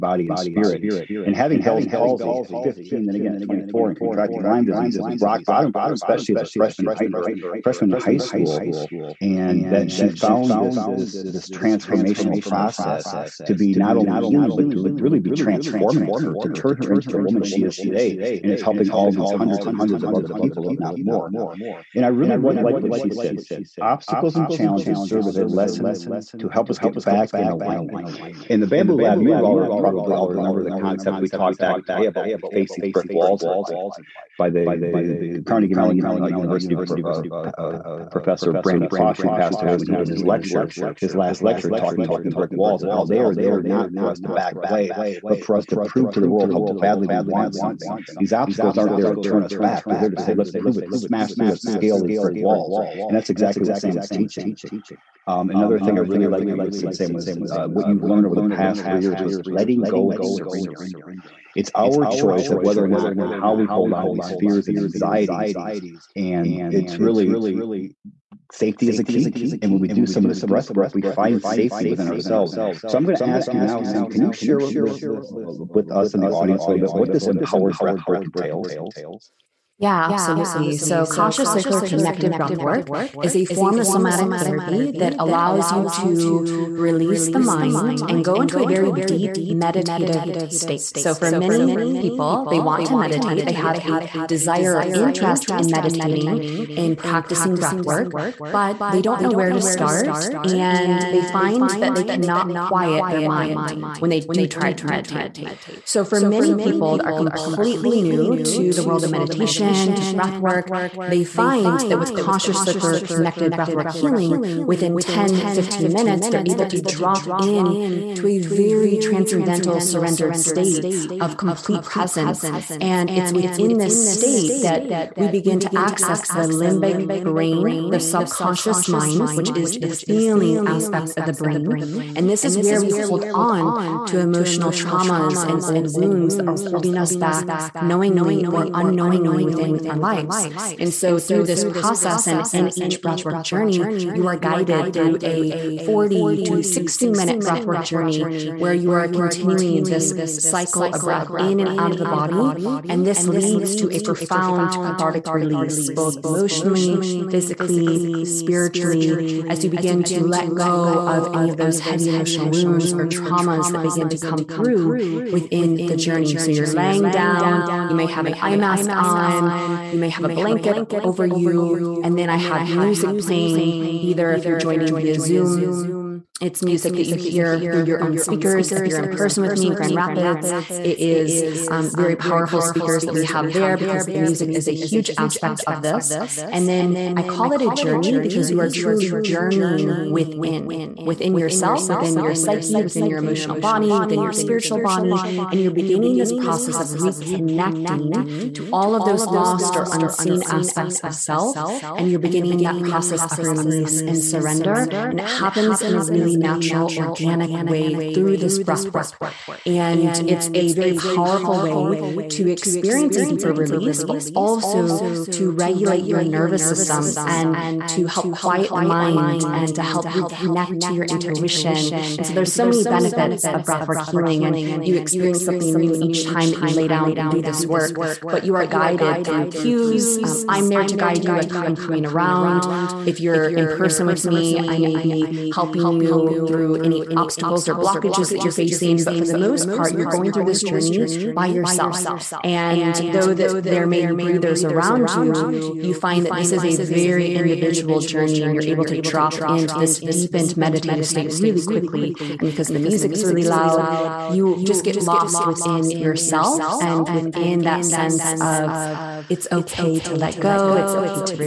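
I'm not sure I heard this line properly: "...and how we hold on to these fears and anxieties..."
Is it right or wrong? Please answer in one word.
right.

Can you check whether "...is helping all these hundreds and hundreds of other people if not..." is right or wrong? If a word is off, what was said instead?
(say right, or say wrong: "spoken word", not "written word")
right.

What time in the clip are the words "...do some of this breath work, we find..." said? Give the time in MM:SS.
01:09.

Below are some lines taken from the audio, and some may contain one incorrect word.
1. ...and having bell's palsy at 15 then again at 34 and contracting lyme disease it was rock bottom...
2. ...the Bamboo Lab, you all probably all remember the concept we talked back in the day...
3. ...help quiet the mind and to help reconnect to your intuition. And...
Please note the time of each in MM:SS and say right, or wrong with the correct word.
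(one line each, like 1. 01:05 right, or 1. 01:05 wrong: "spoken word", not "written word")
1. 00:01 wrong: "24", not "34"
2. 00:28 right
3. 03:38 right.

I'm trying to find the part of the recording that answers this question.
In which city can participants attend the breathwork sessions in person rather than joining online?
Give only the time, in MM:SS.
02:59.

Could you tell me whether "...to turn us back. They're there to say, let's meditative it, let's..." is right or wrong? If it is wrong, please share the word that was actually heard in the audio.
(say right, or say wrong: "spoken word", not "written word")
wrong: "prove", not "meditative".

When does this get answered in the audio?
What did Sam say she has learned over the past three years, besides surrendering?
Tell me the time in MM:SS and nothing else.
00:59.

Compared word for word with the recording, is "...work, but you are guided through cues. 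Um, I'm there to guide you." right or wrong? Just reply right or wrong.
right.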